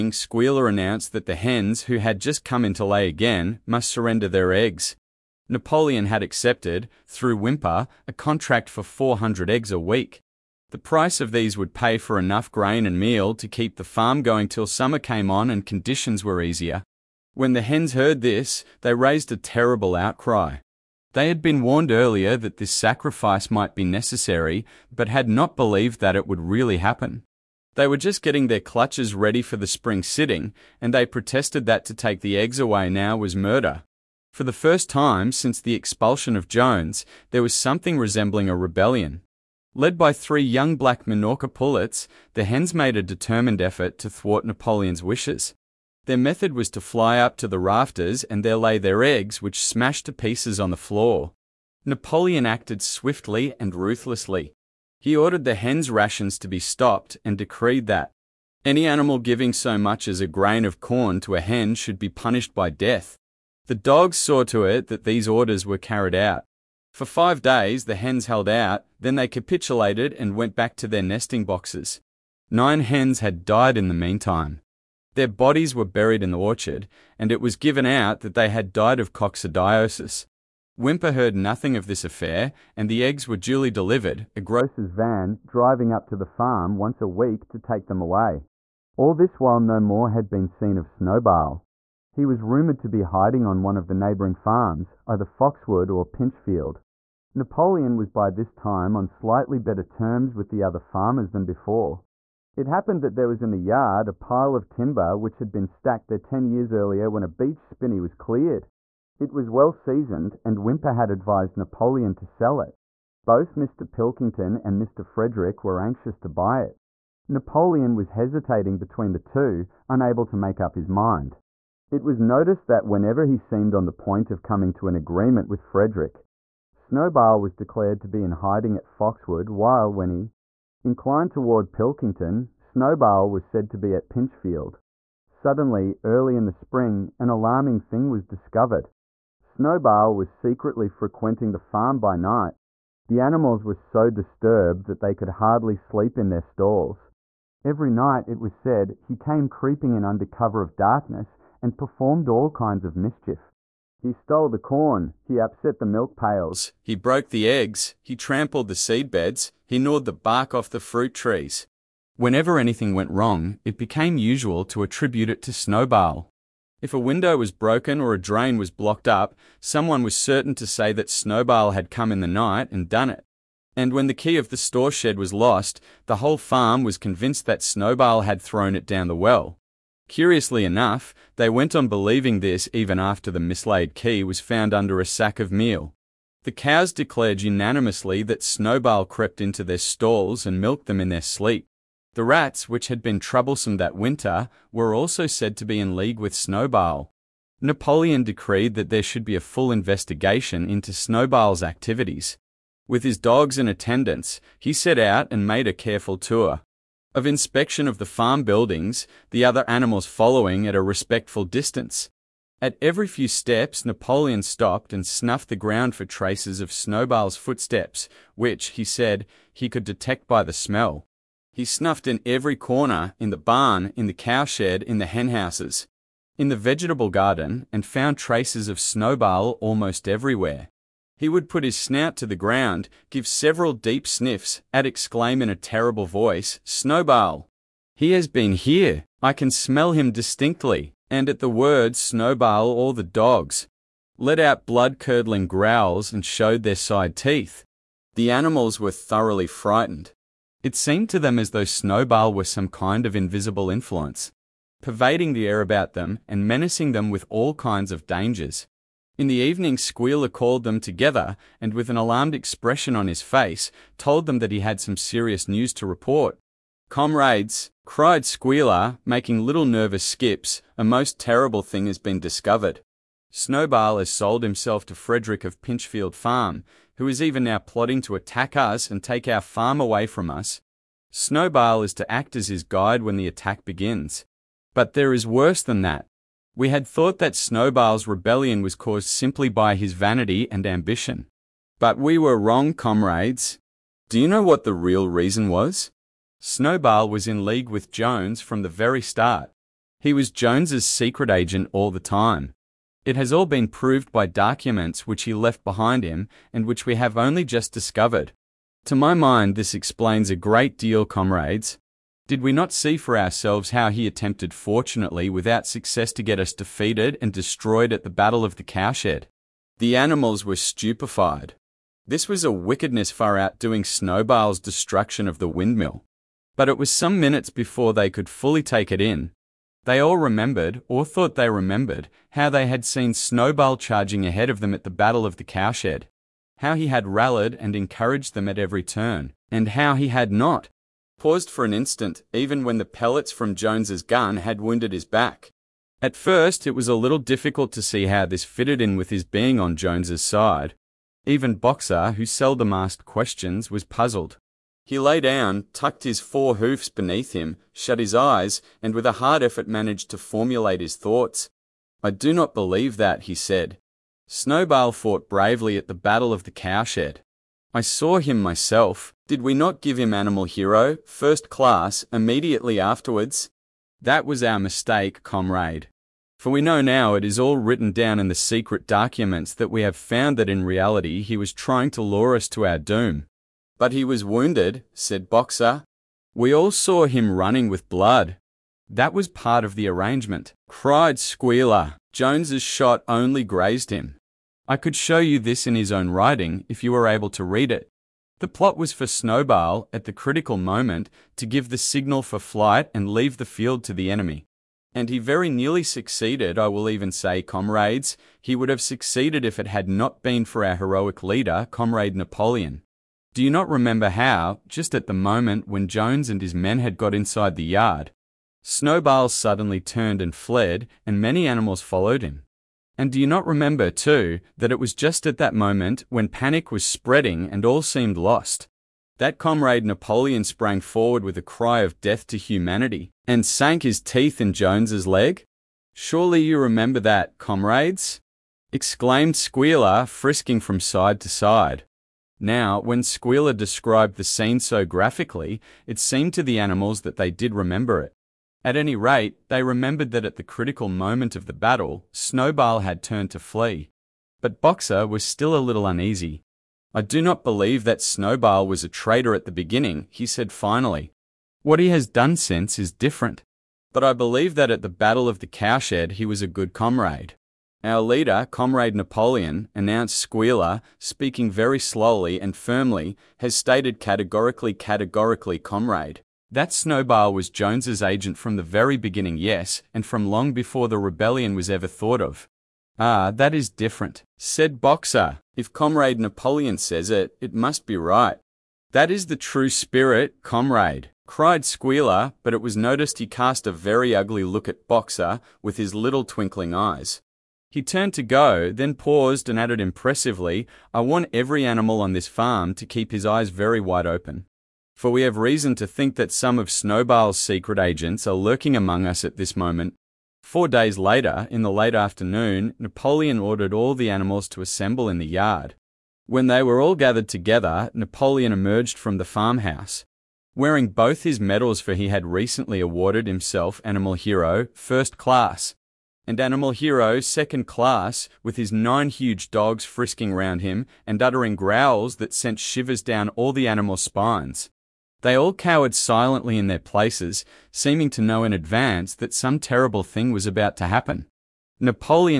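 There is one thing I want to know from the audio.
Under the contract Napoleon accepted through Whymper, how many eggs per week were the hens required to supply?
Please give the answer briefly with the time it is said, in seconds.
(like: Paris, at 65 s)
400, at 8 s.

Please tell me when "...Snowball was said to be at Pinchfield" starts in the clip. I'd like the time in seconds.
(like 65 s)
132 s.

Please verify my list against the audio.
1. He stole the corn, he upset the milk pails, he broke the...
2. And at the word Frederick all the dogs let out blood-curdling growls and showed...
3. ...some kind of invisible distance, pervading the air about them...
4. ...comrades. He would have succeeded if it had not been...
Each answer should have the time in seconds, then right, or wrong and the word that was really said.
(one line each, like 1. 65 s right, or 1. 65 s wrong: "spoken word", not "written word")
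1. 153 s right
2. 241 s wrong: "Snowball", not "Frederick"
3. 252 s wrong: "influence", not "distance"
4. 407 s right.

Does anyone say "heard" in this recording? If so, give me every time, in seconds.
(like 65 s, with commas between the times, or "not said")
17 s, 81 s.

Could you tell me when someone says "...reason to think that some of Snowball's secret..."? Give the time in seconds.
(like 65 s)
505 s.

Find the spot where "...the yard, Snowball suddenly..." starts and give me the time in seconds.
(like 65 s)
417 s.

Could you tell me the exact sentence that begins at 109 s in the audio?
It was well seasoned, and Whymper had advised Napoleon to sell it.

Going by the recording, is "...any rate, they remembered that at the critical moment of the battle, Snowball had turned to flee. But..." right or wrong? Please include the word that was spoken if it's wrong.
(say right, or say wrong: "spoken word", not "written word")
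right.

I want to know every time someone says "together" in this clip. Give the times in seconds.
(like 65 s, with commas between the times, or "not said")
260 s, 517 s.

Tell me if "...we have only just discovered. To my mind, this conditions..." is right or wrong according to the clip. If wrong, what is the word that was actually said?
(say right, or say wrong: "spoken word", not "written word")
wrong: "explains", not "conditions".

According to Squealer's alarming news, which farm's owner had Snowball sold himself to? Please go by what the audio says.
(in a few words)
Pinchfield Farm.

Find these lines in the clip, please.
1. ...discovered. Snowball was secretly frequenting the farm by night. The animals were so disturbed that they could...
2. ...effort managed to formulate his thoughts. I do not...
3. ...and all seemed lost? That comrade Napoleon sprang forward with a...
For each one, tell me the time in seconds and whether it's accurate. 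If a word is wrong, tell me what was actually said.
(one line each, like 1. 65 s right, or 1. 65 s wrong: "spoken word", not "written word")
1. 138 s right
2. 359 s right
3. 427 s right.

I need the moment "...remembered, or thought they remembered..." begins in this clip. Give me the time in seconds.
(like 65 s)
330 s.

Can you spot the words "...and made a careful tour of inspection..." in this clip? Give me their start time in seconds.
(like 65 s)
205 s.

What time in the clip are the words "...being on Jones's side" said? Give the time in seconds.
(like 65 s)
349 s.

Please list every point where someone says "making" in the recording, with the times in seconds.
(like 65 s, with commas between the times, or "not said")
269 s.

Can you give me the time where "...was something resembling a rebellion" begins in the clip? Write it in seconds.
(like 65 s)
37 s.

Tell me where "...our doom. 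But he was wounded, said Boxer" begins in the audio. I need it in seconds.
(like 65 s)
382 s.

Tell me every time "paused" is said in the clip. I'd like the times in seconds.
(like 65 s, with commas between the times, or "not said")
341 s, 498 s.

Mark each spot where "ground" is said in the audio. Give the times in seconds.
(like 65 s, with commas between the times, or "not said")
215 s, 232 s.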